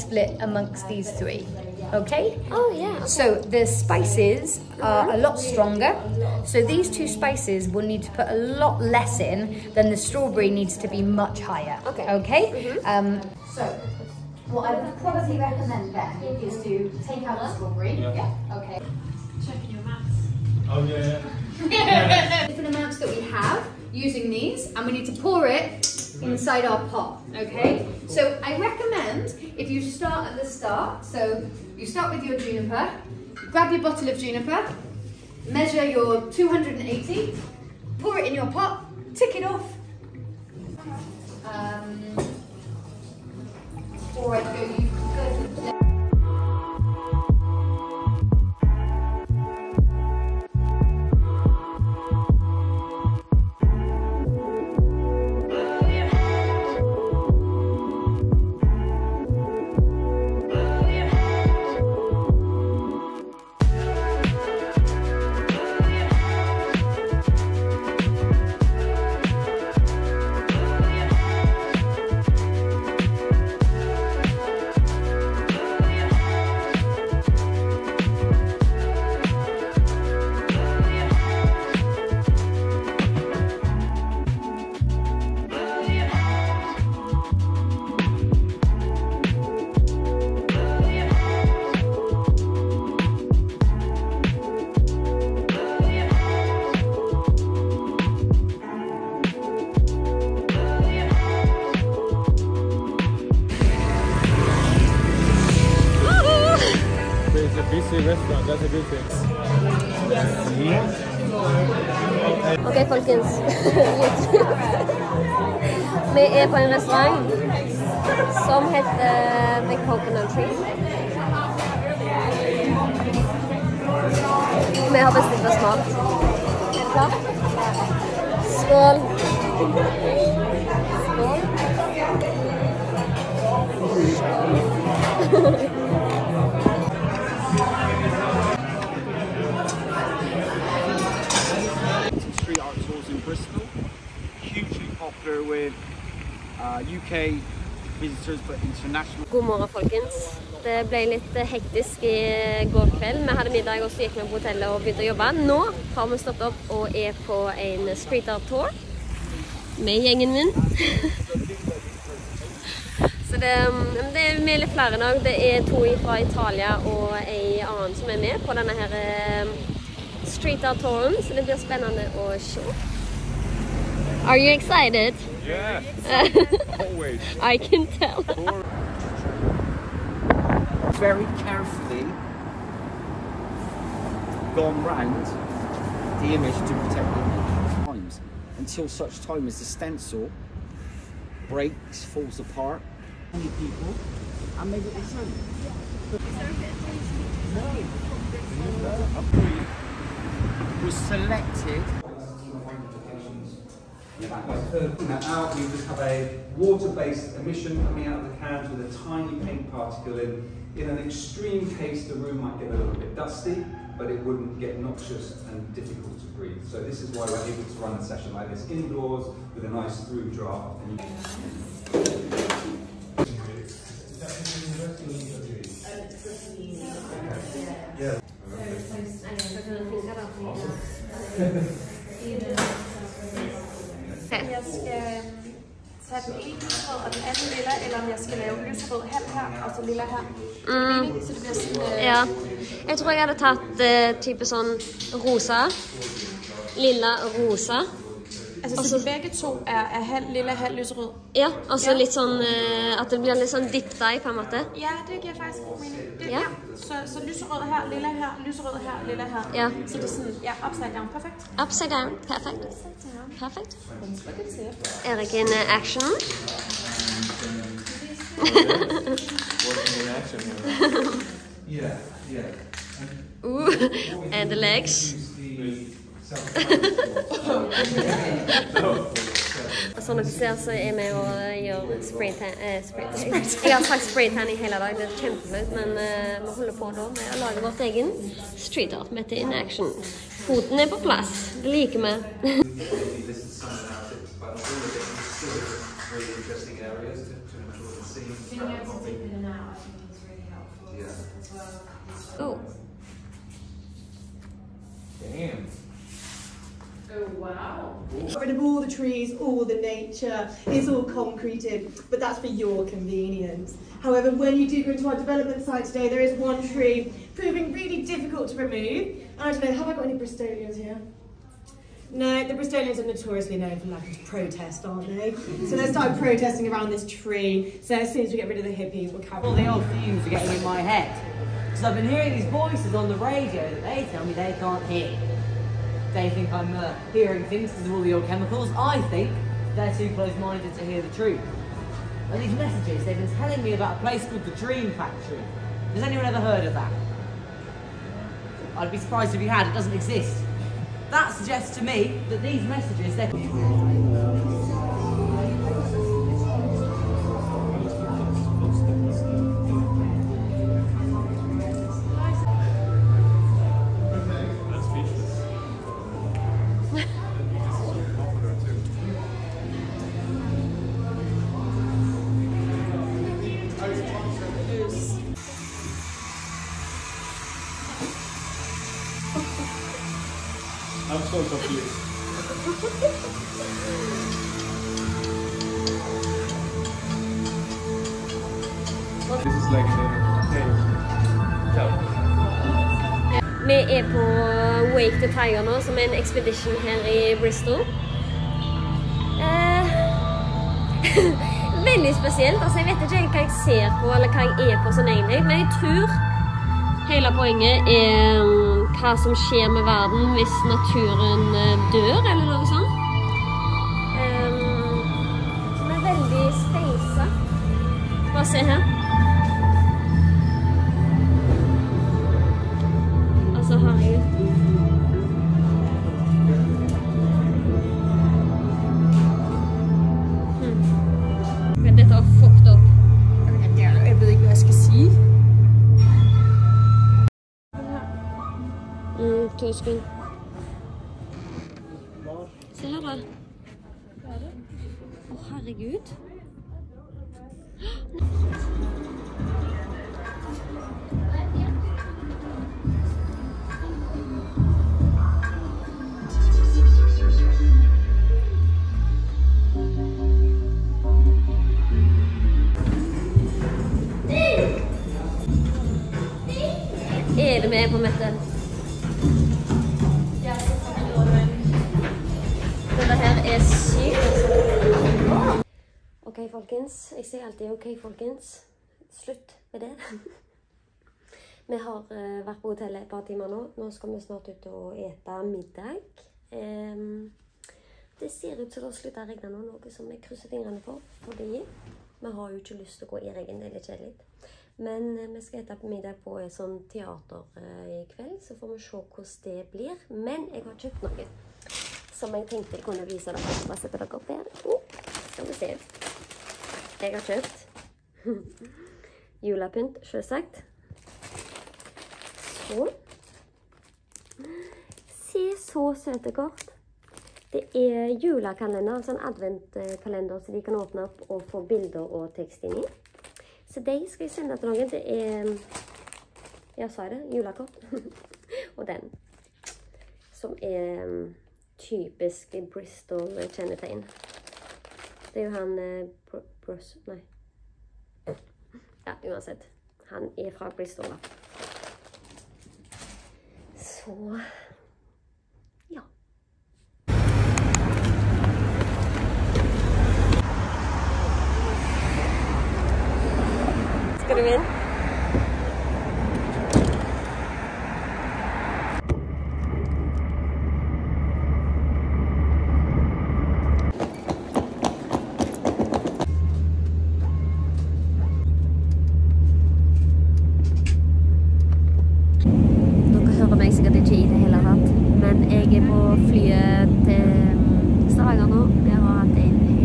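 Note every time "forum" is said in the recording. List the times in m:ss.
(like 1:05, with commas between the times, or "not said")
not said.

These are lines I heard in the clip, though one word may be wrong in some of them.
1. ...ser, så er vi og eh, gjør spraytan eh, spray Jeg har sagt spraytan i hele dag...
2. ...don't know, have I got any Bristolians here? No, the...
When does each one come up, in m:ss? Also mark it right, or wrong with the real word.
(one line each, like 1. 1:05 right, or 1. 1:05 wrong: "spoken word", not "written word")
1. 4:40 right
2. 5:19 right.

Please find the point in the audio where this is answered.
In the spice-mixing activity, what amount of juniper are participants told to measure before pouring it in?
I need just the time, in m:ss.
0:36.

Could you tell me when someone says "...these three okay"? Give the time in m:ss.
0:00.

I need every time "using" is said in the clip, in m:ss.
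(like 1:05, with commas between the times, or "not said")
0:23.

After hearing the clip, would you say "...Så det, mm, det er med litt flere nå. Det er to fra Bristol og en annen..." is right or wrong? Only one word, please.
wrong.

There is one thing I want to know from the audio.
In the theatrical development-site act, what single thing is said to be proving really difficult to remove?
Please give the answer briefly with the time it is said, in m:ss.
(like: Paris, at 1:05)
One tree, at 5:16.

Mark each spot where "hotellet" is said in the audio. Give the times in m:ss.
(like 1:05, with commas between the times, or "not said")
2:34, 8:02.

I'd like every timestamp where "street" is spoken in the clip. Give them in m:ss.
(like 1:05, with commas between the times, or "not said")
2:38, 2:50, 4:48.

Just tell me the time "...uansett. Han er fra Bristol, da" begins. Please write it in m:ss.
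8:59.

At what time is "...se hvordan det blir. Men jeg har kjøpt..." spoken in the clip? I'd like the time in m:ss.
8:18.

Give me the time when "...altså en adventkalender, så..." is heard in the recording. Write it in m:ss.
8:38.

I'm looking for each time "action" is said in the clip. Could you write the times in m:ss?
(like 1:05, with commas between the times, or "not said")
4:25, 4:49.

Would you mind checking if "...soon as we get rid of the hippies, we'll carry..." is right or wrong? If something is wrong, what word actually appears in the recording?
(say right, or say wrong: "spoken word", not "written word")
right.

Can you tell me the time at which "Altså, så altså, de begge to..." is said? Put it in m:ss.
4:08.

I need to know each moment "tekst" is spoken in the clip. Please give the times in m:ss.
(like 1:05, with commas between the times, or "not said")
8:42.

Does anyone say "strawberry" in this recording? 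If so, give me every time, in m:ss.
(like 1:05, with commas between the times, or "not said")
0:09, 0:17.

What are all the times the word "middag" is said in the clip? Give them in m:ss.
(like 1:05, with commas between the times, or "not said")
2:33, 8:05, 8:15.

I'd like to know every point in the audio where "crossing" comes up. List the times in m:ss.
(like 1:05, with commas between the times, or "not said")
not said.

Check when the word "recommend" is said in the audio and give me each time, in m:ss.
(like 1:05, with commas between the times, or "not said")
0:15, 0:28.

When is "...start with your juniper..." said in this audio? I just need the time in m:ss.
0:31.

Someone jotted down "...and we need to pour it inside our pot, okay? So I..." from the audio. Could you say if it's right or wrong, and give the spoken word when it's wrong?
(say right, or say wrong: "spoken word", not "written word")
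right.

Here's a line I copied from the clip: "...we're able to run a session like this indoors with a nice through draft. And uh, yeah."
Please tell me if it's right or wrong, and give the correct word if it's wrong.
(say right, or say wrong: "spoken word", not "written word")
right.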